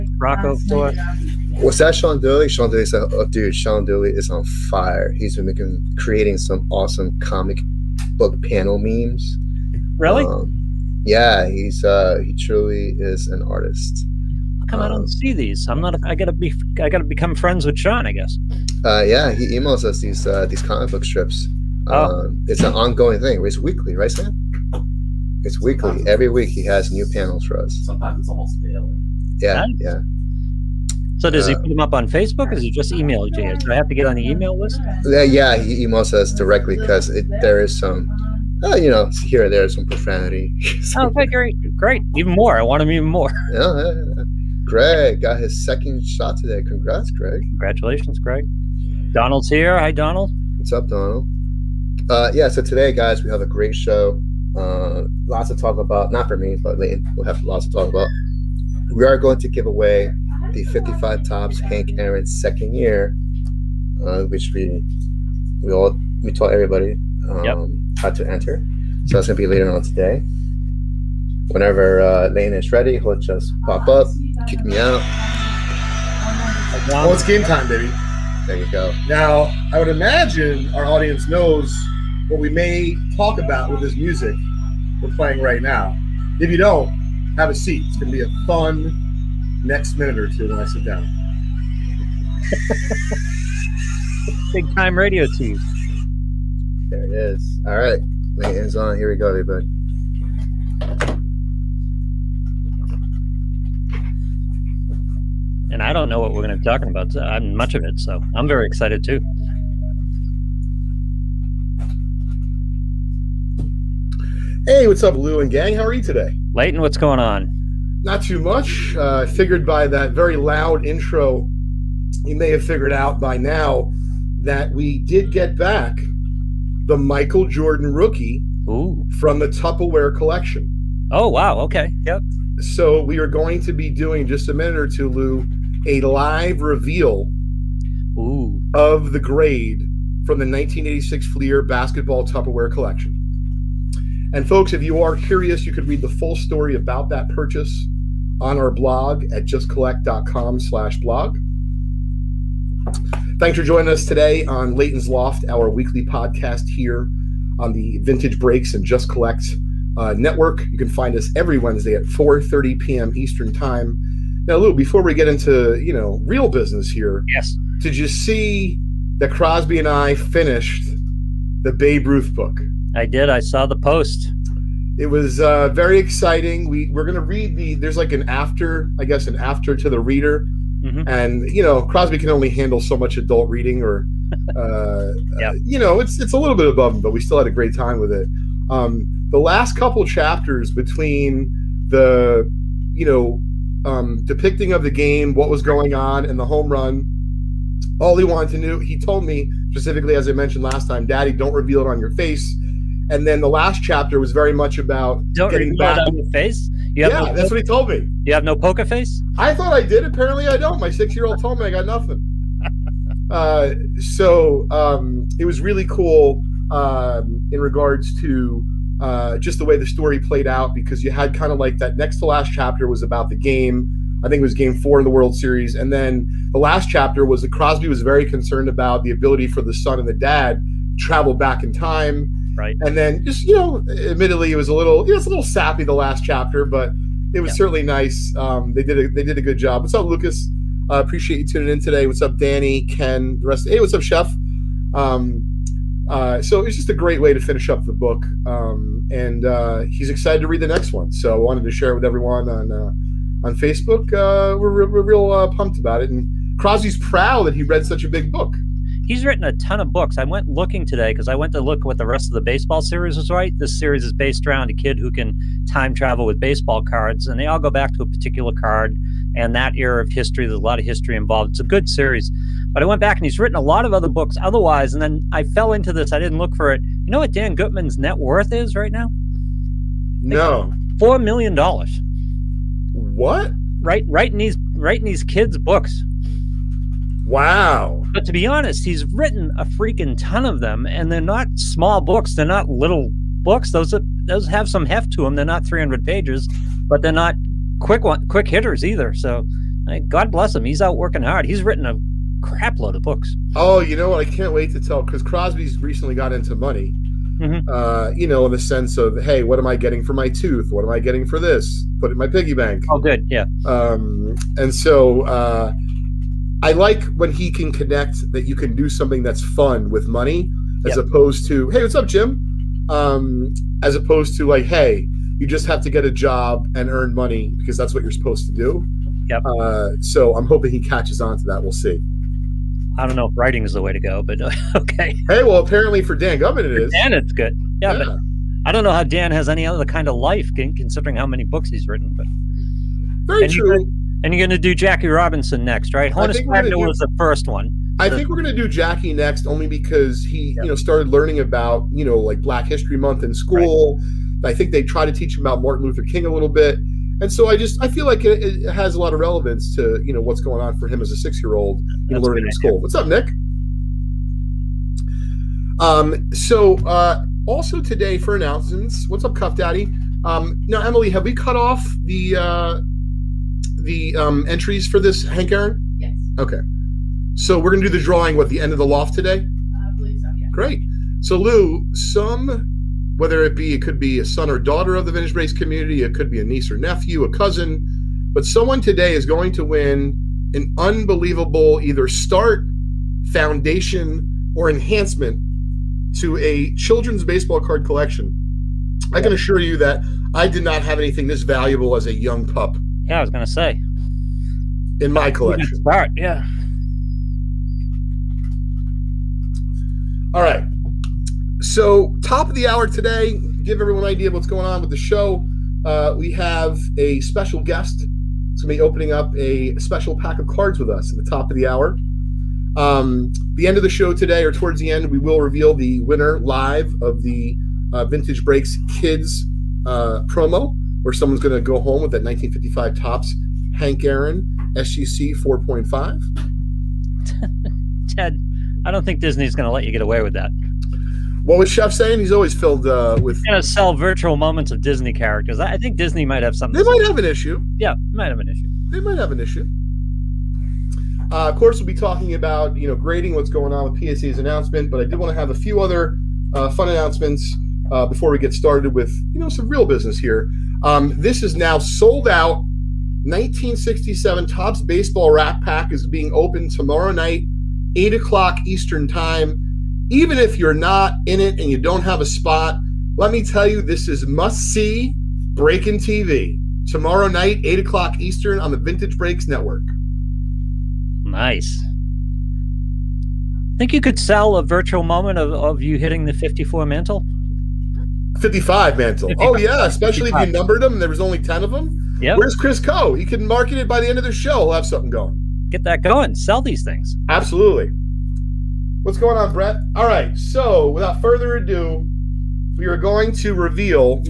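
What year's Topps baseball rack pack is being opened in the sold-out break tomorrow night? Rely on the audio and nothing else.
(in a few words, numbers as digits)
1967.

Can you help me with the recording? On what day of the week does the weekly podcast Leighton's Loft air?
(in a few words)
Wednesday.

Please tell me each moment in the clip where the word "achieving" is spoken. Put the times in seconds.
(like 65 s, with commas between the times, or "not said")
not said.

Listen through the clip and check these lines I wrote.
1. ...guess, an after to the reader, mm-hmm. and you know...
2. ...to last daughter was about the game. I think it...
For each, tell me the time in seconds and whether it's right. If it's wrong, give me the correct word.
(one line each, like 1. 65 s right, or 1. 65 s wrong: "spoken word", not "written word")
1. 179 s right
2. 222 s wrong: "chapter", not "daughter".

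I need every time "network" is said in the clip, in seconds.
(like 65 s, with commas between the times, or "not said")
160 s, 479 s.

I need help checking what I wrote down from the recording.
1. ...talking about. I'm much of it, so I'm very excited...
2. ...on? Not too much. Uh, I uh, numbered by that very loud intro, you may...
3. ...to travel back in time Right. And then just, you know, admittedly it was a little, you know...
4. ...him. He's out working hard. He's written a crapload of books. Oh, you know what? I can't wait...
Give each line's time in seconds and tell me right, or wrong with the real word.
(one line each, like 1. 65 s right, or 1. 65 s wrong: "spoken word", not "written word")
1. 106 s right
2. 117 s wrong: "figured", not "numbered"
3. 230 s right
4. 300 s right.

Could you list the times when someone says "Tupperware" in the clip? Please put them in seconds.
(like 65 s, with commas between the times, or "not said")
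129 s, 142 s.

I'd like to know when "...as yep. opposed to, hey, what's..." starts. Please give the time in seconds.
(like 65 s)
320 s.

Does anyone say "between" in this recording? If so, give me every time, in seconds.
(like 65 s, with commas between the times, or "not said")
190 s.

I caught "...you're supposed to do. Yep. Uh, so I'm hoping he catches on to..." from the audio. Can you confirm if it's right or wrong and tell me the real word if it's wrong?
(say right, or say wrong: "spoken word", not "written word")
right.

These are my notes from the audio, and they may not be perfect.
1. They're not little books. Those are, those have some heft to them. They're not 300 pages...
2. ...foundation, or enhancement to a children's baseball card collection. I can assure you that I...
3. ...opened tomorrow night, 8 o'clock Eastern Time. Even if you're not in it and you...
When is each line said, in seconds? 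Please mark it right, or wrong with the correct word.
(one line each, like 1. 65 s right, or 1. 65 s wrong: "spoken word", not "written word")
1. 292 s right
2. 393 s right
3. 466 s right.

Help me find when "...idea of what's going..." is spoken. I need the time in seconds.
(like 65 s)
414 s.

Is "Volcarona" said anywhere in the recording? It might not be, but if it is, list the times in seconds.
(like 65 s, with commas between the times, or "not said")
not said.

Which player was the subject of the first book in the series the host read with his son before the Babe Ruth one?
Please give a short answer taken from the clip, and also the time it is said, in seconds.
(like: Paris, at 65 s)
Honus Wagner, at 346 s.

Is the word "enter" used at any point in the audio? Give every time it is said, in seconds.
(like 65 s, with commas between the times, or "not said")
68 s.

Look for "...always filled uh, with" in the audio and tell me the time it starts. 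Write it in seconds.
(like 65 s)
442 s.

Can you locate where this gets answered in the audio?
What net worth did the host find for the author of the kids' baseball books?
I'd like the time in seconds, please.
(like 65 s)
280 s.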